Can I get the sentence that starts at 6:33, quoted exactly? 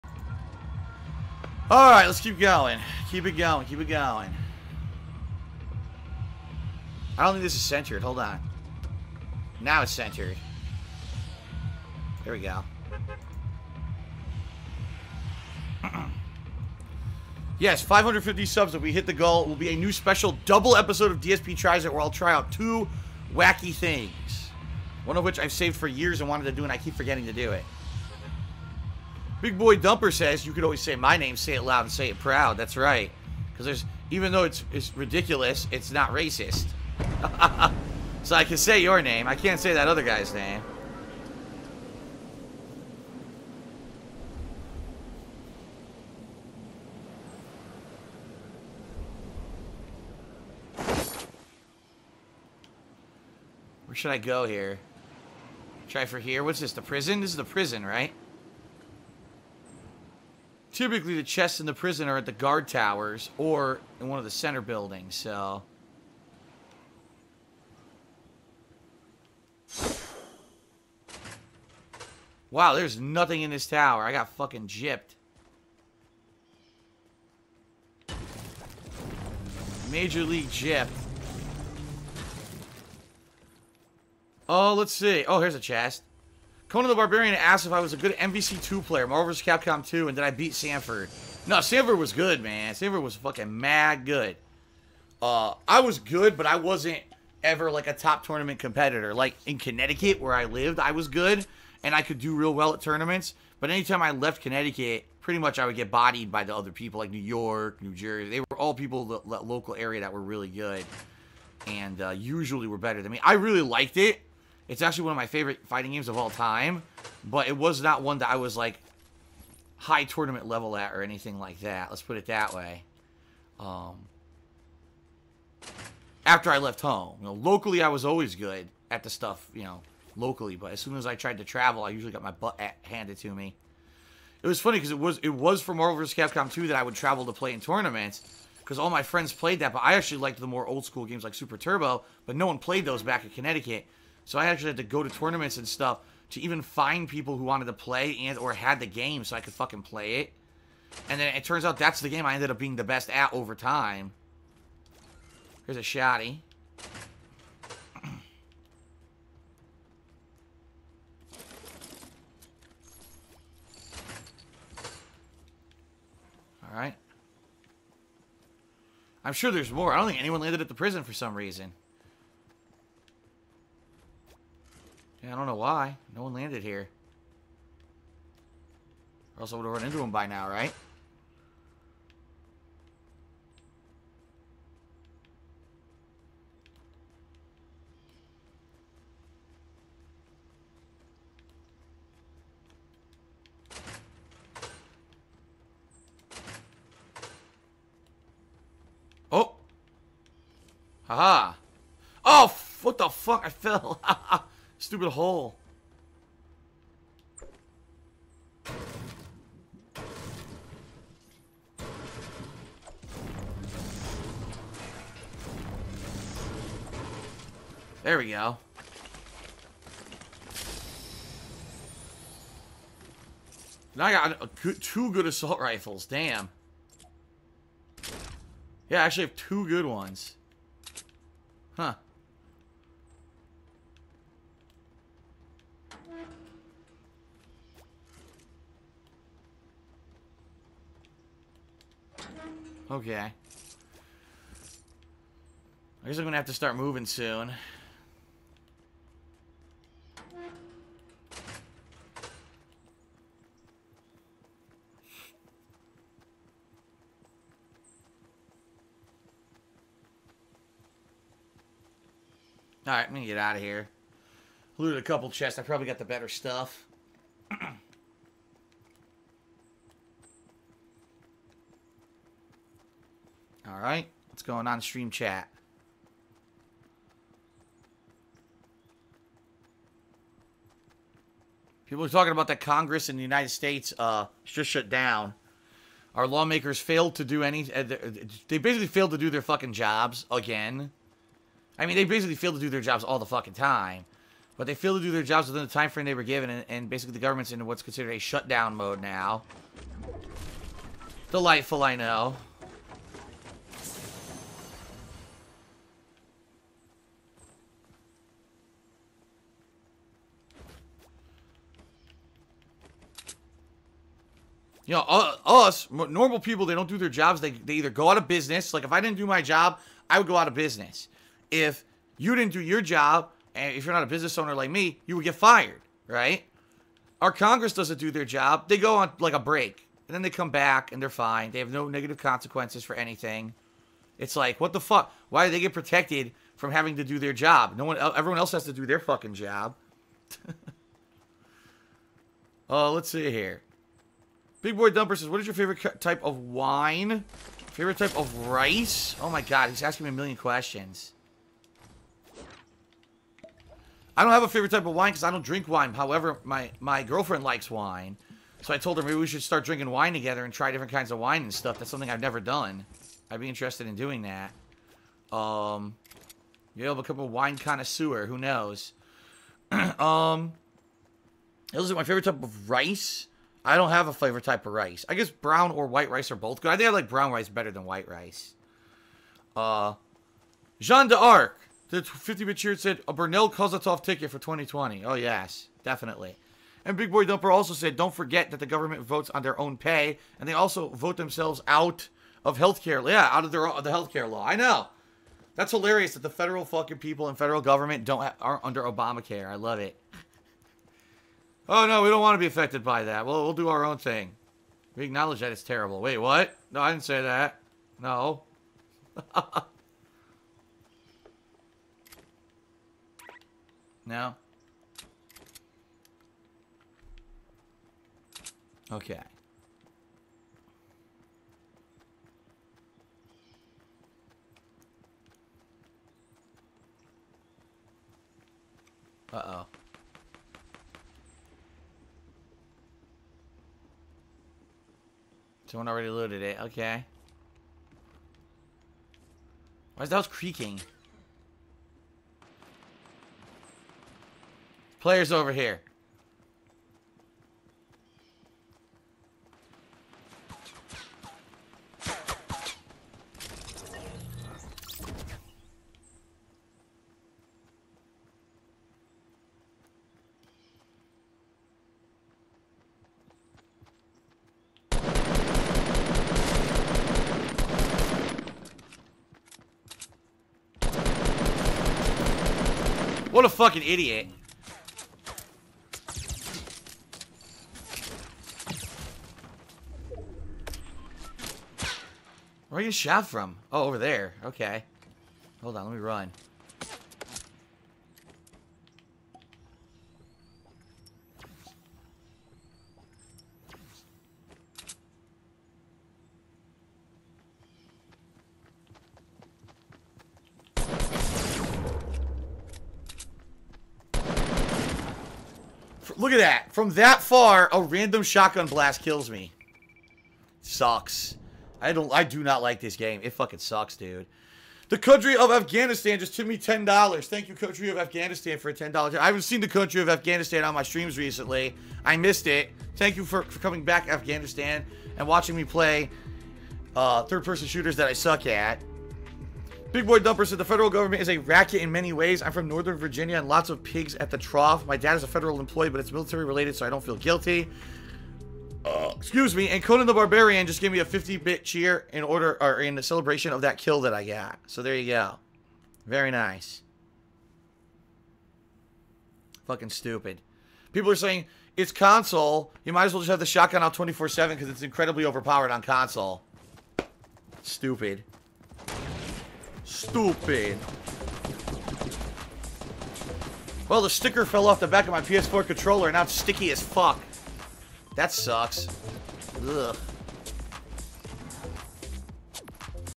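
Yeah, out of their of the healthcare law.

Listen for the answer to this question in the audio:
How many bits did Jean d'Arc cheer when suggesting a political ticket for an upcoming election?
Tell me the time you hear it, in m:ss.
6:22.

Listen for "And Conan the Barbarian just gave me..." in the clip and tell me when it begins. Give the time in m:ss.
8:59.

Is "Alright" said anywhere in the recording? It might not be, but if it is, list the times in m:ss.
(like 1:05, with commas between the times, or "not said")
0:01, 2:46, 4:22.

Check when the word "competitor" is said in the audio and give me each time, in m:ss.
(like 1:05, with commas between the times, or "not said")
1:38.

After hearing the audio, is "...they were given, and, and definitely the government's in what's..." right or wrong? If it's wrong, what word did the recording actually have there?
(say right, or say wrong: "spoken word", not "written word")
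wrong: "basically", not "definitely".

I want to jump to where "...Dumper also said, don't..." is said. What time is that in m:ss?
6:27.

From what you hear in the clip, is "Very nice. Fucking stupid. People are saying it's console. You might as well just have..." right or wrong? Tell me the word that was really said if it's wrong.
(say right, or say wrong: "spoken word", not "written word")
right.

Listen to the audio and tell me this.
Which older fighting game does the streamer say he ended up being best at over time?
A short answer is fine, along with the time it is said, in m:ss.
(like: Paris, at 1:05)
Super Turbo, at 2:21.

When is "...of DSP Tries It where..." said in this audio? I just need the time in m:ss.
0:21.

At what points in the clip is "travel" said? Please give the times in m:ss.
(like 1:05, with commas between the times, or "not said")
2:11, 2:16.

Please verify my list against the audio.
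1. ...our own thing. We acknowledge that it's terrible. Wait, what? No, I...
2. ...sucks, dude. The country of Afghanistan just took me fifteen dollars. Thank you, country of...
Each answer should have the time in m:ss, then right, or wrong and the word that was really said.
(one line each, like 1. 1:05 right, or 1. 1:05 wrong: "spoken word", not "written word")
1. 6:43 right
2. 8:33 wrong: "ten", not "fifteen".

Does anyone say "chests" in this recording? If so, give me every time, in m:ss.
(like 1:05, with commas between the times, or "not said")
1:01, 1:25, 4:25.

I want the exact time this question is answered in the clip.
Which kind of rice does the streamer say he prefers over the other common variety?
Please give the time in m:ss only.
6:17.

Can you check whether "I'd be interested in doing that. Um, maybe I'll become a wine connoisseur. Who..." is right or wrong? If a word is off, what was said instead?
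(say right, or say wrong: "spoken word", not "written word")
right.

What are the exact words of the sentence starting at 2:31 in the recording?
And then it turns out that's the game I ended up being the best at over time.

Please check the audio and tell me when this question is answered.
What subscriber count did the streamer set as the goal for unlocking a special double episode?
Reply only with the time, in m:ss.
0:17.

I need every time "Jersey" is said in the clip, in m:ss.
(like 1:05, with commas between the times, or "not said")
1:47.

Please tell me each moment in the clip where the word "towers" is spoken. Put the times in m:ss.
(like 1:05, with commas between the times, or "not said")
1:02, 1:13.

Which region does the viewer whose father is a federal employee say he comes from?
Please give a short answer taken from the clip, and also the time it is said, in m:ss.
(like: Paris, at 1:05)
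Northern Virginia, at 8:52.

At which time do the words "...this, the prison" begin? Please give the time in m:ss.
0:56.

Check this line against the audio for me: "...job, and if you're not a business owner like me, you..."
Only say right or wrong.
right.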